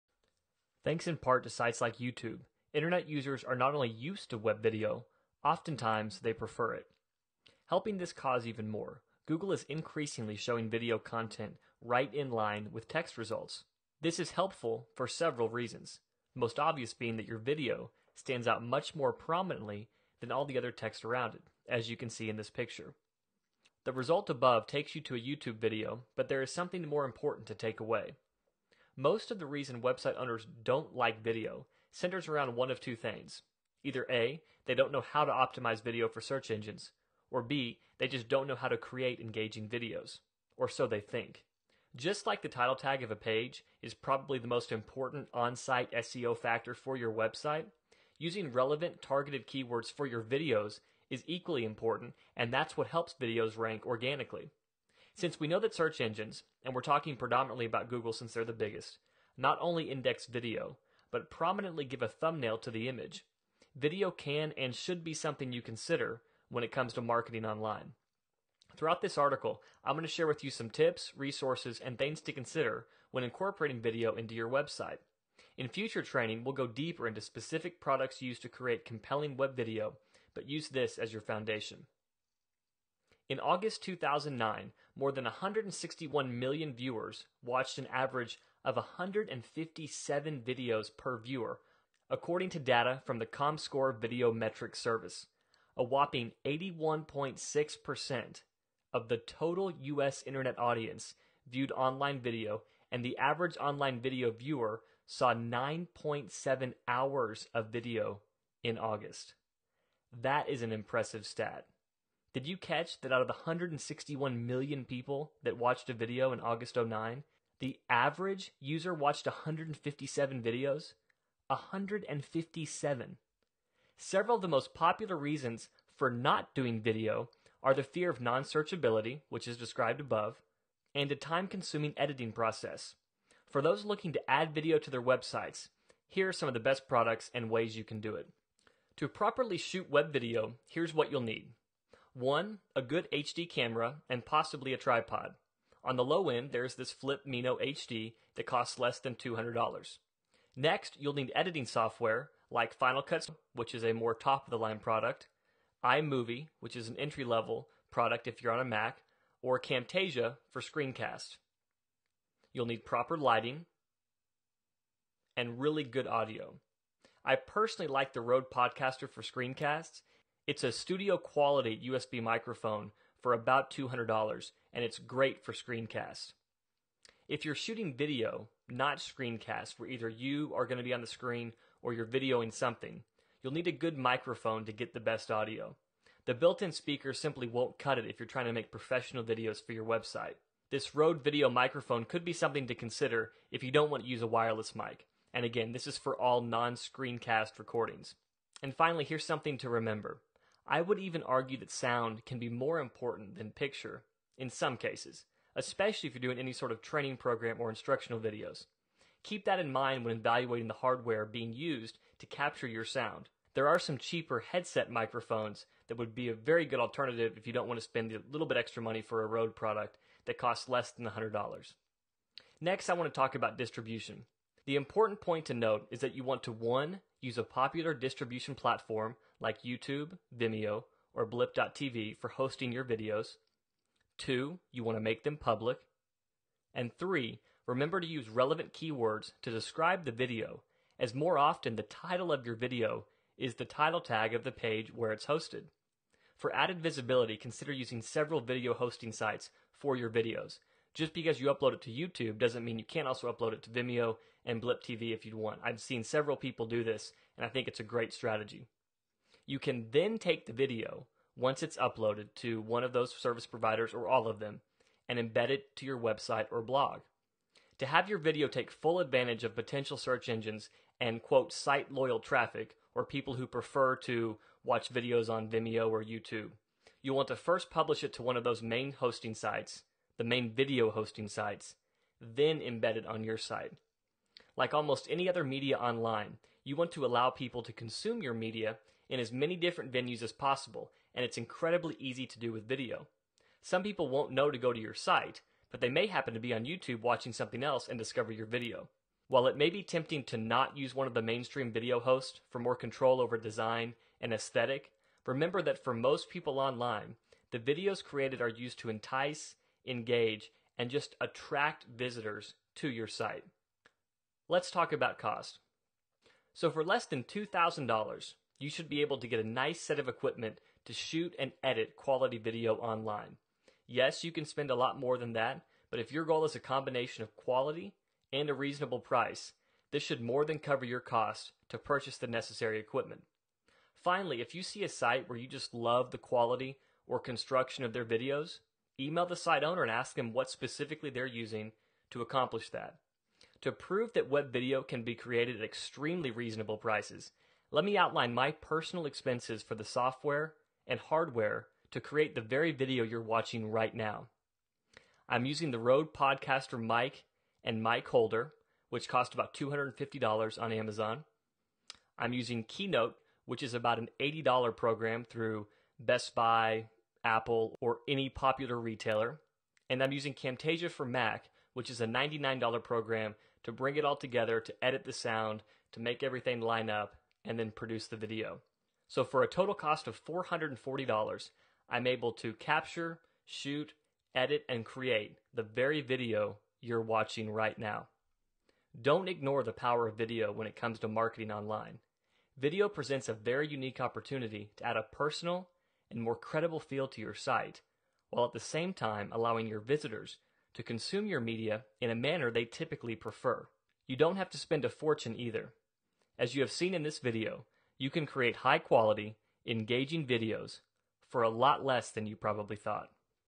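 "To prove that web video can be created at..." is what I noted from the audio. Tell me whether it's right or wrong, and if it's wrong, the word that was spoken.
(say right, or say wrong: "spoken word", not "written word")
right.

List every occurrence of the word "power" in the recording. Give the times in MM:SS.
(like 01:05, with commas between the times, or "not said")
06:29.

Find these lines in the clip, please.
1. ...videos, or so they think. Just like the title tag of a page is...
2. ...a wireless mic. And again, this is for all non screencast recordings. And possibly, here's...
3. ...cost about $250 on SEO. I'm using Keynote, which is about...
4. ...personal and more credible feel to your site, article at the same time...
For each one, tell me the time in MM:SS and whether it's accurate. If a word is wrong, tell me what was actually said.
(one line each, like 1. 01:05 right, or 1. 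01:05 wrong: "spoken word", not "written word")
1. 00:39 right
2. 03:14 wrong: "finally", not "possibly"
3. 05:59 wrong: "Amazon", not "SEO"
4. 06:35 wrong: "while", not "article".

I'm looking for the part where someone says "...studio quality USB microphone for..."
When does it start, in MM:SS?
02:50.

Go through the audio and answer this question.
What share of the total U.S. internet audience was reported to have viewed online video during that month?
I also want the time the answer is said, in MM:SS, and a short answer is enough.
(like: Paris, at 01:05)
81.6%, at 01:36.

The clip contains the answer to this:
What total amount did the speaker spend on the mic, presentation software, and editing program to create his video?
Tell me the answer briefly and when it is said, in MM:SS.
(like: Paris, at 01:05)
$440, at 06:20.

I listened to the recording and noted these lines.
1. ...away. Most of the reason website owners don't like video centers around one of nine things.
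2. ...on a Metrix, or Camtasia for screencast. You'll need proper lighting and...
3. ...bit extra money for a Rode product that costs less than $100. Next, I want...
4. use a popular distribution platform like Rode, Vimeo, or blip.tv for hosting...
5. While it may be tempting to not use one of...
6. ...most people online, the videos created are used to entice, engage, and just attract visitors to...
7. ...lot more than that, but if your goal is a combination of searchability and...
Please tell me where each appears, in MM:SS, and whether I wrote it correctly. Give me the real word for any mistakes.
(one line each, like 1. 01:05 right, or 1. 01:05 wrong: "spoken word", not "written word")
1. 00:27 wrong: "two", not "nine"
2. 02:38 wrong: "Mac", not "Metrix"
3. 03:38 right
4. 03:47 wrong: "YouTube", not "Rode"
5. 04:59 right
6. 05:05 right
7. 05:24 wrong: "quality", not "searchability".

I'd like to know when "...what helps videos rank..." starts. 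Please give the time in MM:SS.
00:52.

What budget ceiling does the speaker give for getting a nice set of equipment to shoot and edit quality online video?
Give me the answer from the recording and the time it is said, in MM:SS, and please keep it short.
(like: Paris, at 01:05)
$2,000, at 05:17.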